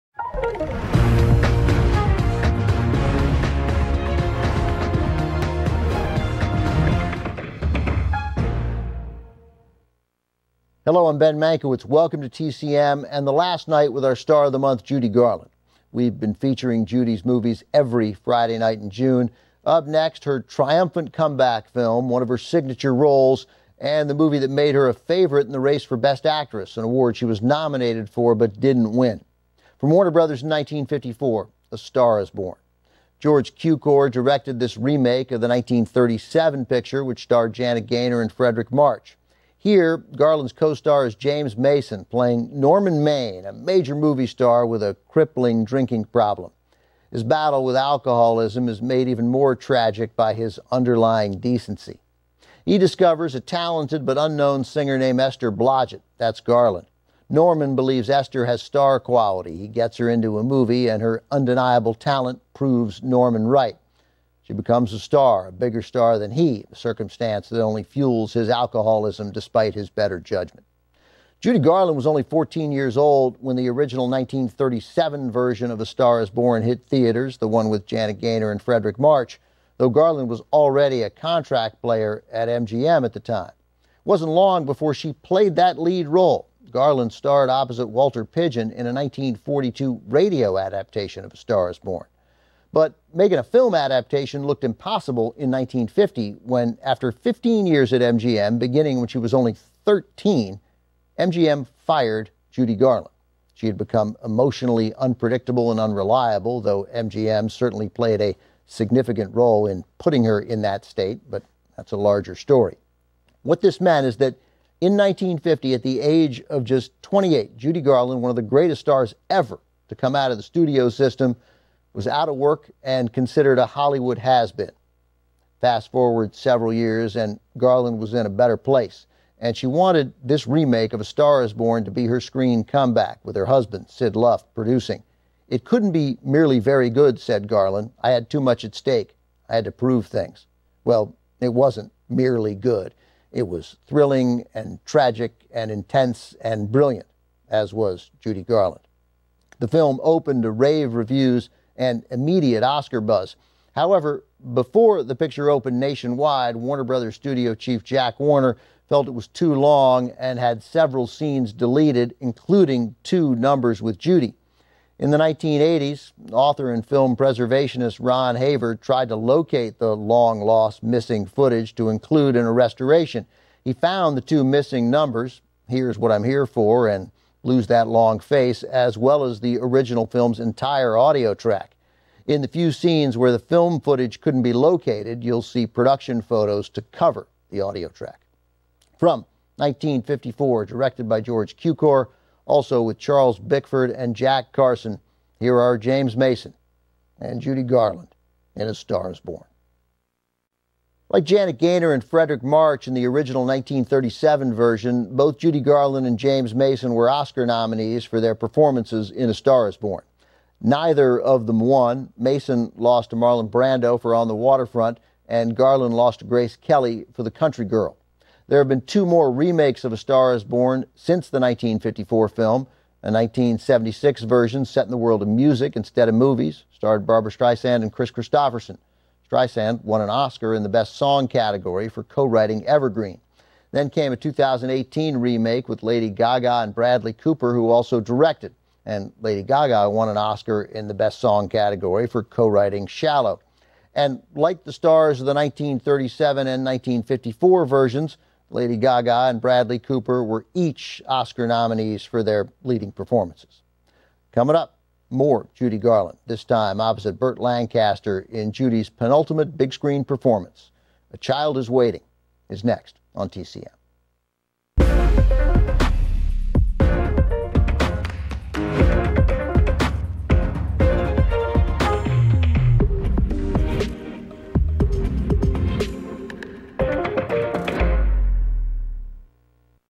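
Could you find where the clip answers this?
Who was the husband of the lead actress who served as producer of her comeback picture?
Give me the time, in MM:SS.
02:13.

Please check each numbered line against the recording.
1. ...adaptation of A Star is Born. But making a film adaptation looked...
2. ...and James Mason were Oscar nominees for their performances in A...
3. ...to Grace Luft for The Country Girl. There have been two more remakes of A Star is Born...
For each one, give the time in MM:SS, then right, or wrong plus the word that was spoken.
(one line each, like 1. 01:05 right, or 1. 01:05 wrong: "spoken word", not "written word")
1. 01:30 right
2. 03:26 right
3. 03:36 wrong: "Kelly", not "Luft".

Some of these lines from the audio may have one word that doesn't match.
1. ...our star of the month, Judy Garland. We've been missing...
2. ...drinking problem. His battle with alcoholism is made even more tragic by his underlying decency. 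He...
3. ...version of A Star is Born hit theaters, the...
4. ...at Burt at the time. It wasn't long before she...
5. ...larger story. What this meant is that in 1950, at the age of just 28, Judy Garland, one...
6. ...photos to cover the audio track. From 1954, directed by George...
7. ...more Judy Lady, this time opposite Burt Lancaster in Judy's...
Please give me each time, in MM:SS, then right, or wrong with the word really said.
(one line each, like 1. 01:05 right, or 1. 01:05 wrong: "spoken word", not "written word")
1. 00:14 wrong: "featuring", not "missing"
2. 00:45 right
3. 01:15 right
4. 01:22 wrong: "MGM", not "Burt"
5. 01:51 right
6. 03:06 right
7. 04:15 wrong: "Garland", not "Lady".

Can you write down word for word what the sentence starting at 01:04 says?
She becomes a star, a bigger star than he, a circumstance that only fuels his alcoholism despite his better judgment.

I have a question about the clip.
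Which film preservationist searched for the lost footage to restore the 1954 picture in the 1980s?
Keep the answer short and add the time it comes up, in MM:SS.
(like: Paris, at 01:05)
Ron Haver, at 02:47.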